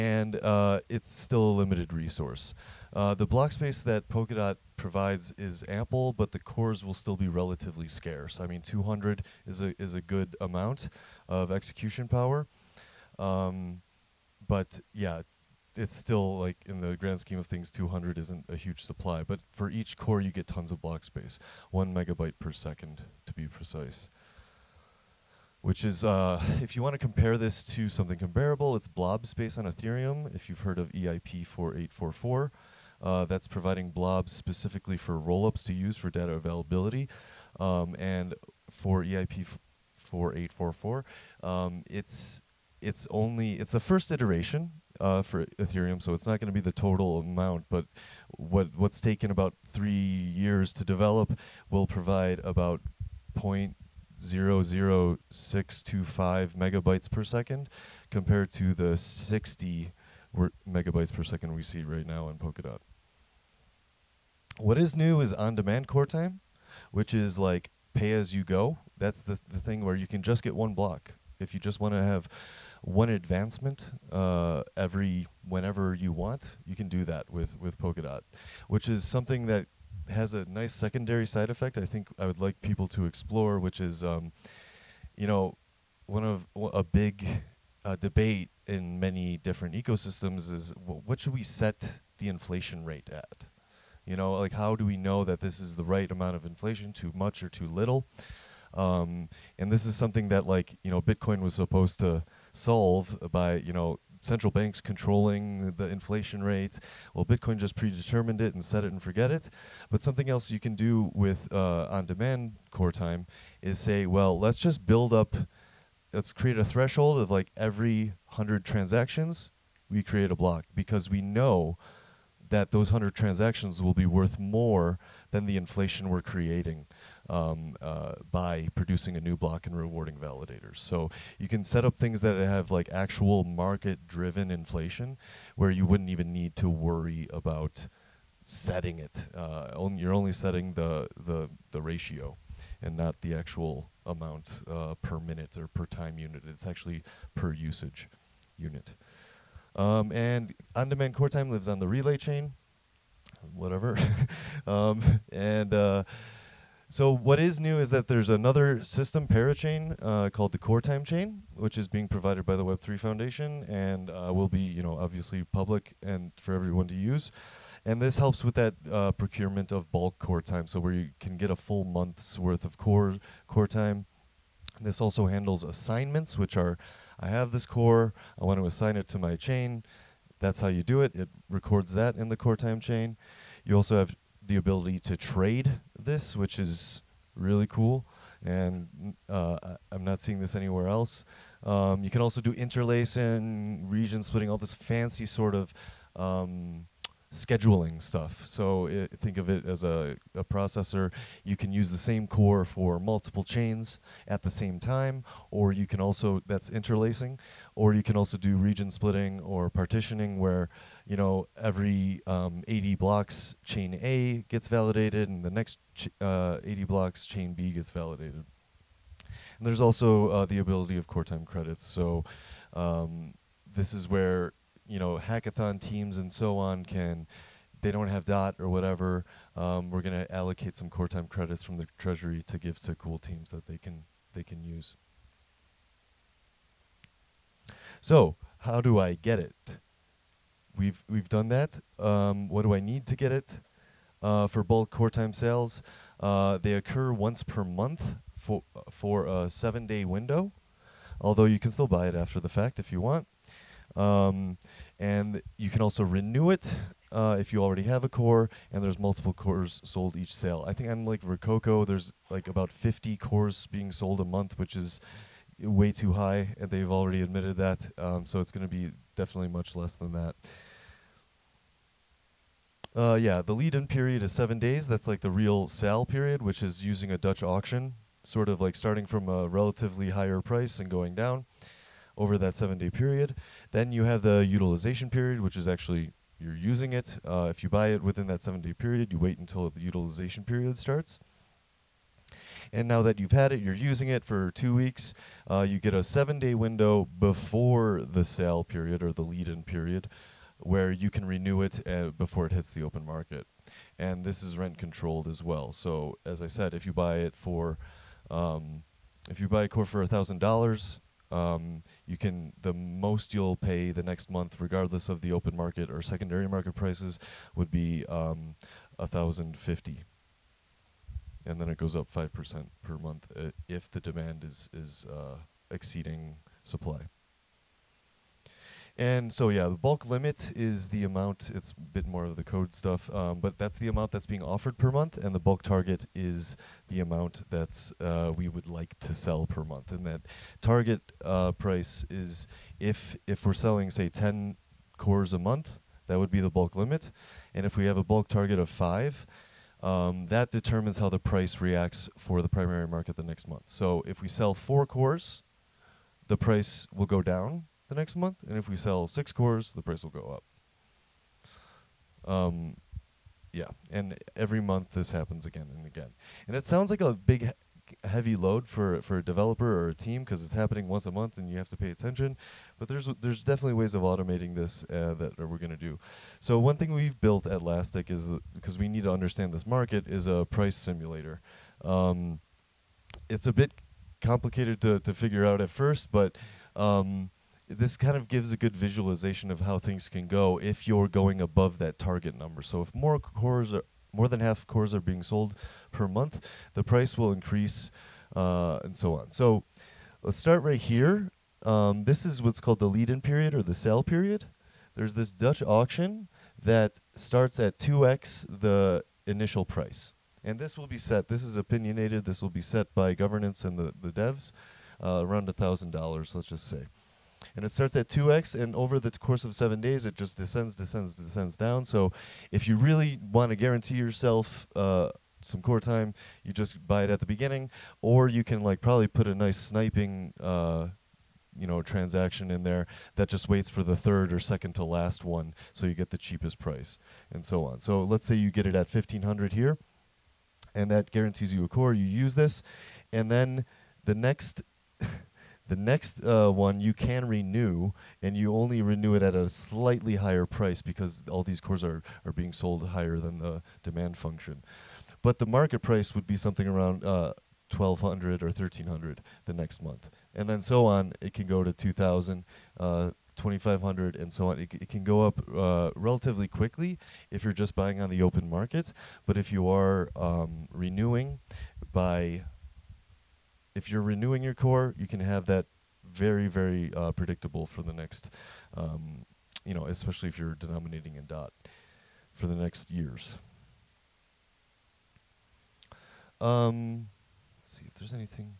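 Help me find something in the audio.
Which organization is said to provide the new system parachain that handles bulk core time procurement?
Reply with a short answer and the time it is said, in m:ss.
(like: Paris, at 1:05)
Web3 Foundation, at 2:42.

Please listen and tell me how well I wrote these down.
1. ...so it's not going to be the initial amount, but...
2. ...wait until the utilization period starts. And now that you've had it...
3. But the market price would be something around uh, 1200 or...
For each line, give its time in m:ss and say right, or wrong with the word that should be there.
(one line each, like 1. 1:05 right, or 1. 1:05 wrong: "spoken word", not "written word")
1. 0:46 wrong: "total", not "initial"
2. 4:49 right
3. 7:35 right.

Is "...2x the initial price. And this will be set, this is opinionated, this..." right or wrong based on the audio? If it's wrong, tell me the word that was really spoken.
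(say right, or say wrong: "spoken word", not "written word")
right.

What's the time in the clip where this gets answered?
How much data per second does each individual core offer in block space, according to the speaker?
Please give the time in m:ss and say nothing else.
0:21.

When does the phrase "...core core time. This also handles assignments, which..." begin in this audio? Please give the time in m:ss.
2:52.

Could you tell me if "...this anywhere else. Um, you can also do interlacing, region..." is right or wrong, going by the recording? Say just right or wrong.
right.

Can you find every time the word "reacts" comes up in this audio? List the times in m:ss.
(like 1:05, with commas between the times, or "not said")
5:51.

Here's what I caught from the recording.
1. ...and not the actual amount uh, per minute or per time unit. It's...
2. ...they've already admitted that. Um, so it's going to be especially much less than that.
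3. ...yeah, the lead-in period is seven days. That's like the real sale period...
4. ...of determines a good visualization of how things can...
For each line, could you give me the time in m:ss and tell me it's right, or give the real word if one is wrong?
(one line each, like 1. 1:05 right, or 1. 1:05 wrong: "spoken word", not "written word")
1. 2:22 right
2. 4:26 wrong: "definitely", not "especially"
3. 4:33 right
4. 6:28 wrong: "gives", not "determines".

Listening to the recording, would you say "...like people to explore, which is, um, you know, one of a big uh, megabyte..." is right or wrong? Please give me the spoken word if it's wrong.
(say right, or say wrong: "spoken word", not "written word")
wrong: "debate", not "megabyte".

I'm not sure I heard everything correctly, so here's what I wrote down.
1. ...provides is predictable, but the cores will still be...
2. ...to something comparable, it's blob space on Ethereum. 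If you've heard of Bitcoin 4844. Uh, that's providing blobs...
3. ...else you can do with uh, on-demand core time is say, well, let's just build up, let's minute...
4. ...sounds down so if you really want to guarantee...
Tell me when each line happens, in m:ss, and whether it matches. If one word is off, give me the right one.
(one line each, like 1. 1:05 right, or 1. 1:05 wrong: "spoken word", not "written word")
1. 0:04 wrong: "ample", not "predictable"
2. 0:27 wrong: "EIP", not "Bitcoin"
3. 1:50 wrong: "create", not "minute"
4. 7:01 wrong: "descends", not "sounds".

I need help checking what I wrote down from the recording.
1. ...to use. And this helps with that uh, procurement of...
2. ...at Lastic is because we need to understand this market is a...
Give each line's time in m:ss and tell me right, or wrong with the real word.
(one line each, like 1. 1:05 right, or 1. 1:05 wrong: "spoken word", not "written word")
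1. 2:46 right
2. 6:17 right.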